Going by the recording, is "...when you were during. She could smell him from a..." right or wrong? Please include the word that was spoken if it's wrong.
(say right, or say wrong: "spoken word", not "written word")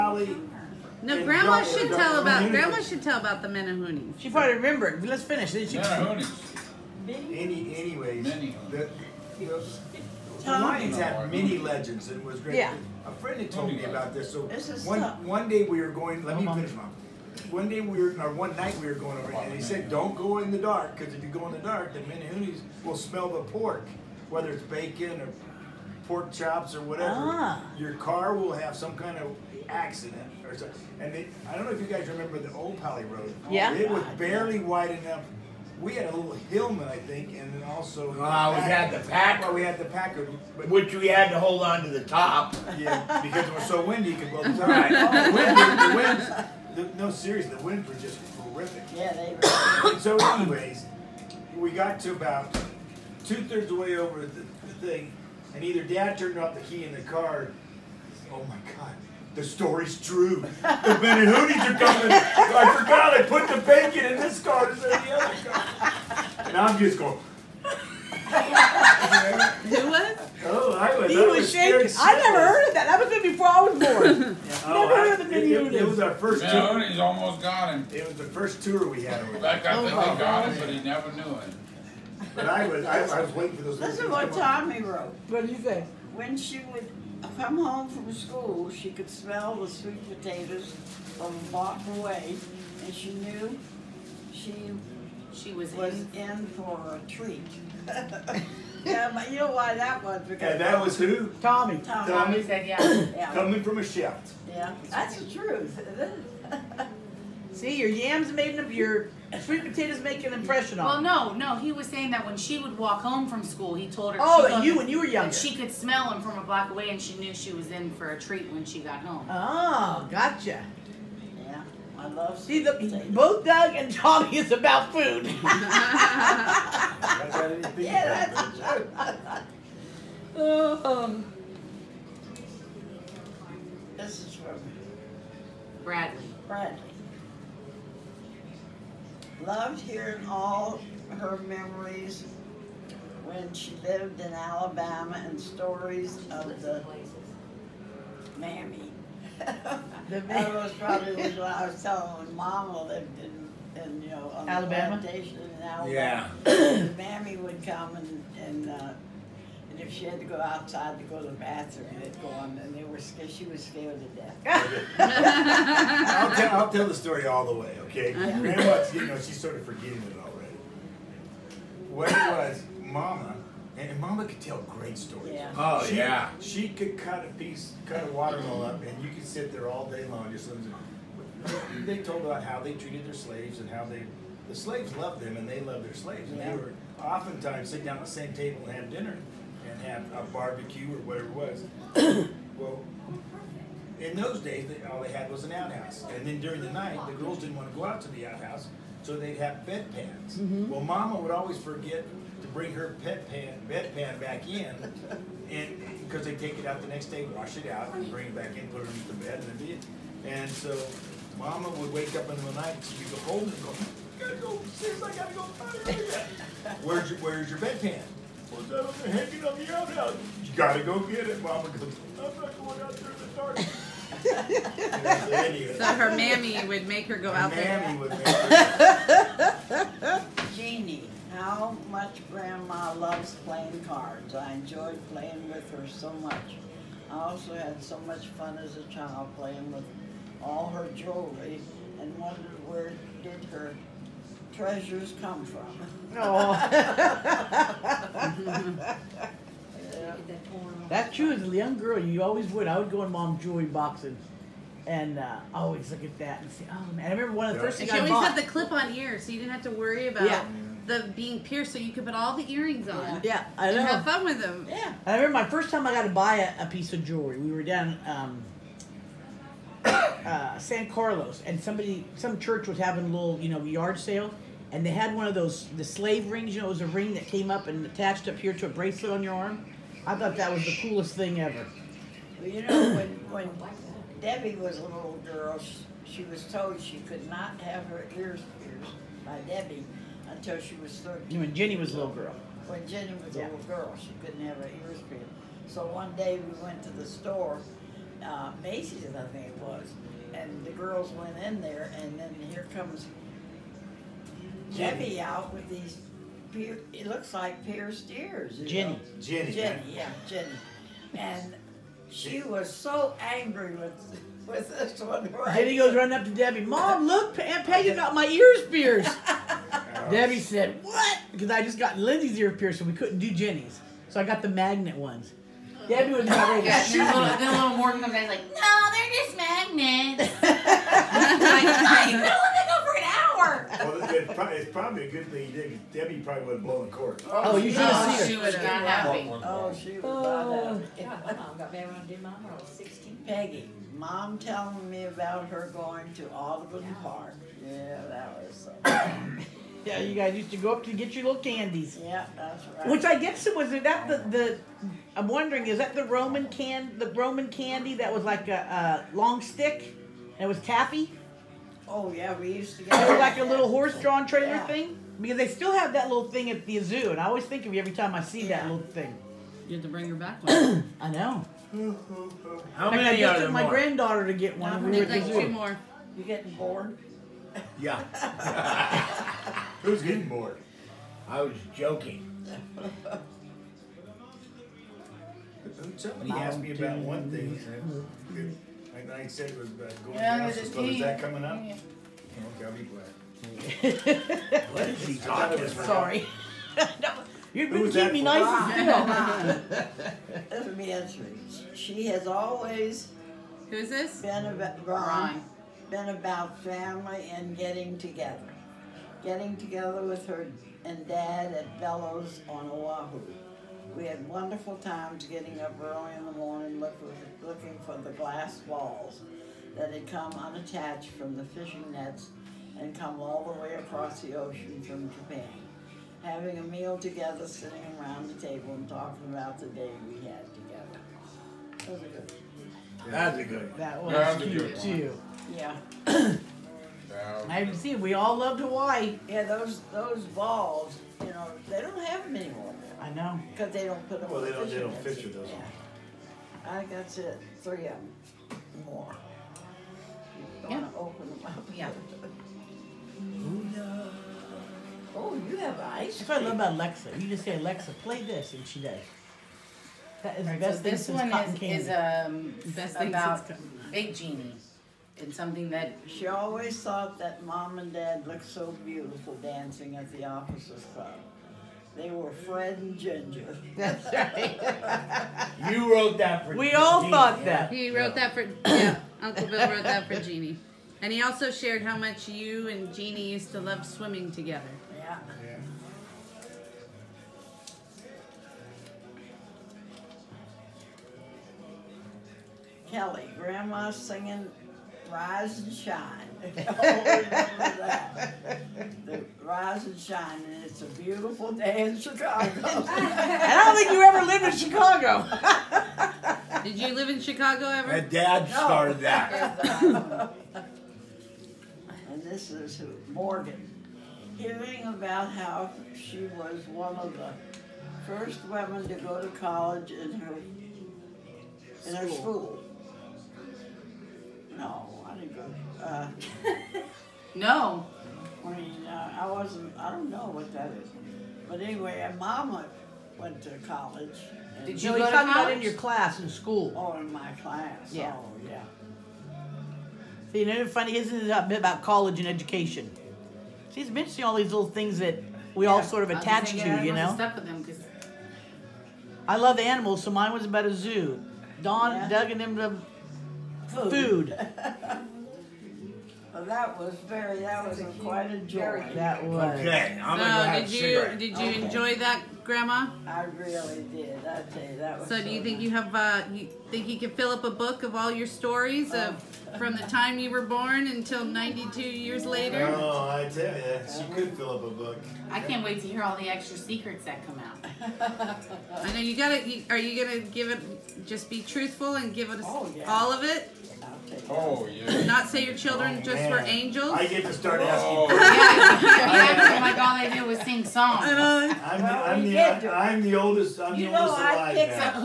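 wrong: "young", not "during".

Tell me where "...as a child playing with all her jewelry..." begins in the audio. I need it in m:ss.
3:58.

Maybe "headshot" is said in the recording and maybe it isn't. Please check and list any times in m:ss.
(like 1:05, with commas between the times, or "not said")
not said.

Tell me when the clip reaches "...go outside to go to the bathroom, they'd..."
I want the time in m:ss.
2:40.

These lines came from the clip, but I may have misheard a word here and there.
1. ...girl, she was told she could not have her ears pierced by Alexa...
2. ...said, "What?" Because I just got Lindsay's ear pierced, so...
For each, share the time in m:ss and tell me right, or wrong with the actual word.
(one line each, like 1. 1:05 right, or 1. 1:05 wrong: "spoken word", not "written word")
1. 4:45 wrong: "Debbie", not "Alexa"
2. 5:20 right.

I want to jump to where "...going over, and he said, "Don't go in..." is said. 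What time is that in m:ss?
0:18.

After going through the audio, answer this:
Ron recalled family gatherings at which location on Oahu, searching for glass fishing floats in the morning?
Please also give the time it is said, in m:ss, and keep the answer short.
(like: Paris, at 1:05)
Bellows, at 6:51.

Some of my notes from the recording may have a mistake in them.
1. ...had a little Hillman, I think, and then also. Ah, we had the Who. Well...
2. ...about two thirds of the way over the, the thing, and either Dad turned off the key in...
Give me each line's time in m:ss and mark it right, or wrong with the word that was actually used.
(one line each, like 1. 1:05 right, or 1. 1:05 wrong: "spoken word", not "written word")
1. 0:35 wrong: "Packard", not "Who"
2. 0:52 right.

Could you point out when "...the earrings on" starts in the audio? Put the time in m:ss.
4:22.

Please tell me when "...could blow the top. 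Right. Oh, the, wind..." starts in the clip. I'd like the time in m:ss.
0:44.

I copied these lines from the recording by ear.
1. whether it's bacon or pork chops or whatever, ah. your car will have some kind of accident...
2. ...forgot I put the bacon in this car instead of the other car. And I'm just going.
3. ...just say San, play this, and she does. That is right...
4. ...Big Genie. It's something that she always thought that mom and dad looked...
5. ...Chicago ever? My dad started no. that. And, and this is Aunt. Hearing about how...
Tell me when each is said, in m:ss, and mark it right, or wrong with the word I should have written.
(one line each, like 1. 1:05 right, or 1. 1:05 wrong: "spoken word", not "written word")
1. 0:24 right
2. 1:02 right
3. 7:37 wrong: "Alexa", not "San"
4. 7:43 right
5. 8:27 wrong: "Morgan", not "Aunt".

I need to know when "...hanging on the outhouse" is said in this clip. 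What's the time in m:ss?
3:39.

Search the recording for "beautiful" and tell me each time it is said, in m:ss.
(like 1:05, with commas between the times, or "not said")
7:48, 8:20.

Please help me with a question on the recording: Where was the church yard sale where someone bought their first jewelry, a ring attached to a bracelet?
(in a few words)
San Carlos.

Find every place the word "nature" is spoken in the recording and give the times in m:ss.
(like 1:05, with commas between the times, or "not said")
not said.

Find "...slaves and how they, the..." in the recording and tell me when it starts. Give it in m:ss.
3:03.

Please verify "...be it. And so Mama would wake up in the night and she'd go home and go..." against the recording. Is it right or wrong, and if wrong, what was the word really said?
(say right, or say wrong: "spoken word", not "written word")
right.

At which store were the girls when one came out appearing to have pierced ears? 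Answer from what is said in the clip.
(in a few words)
Macy's.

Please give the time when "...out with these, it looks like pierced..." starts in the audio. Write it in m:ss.
5:05.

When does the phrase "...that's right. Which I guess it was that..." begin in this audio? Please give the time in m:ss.
5:52.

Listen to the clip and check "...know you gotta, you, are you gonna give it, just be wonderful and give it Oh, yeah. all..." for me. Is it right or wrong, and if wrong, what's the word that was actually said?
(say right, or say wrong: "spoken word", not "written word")
wrong: "truthful", not "wonderful".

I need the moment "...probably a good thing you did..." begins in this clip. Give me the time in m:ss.
5:34.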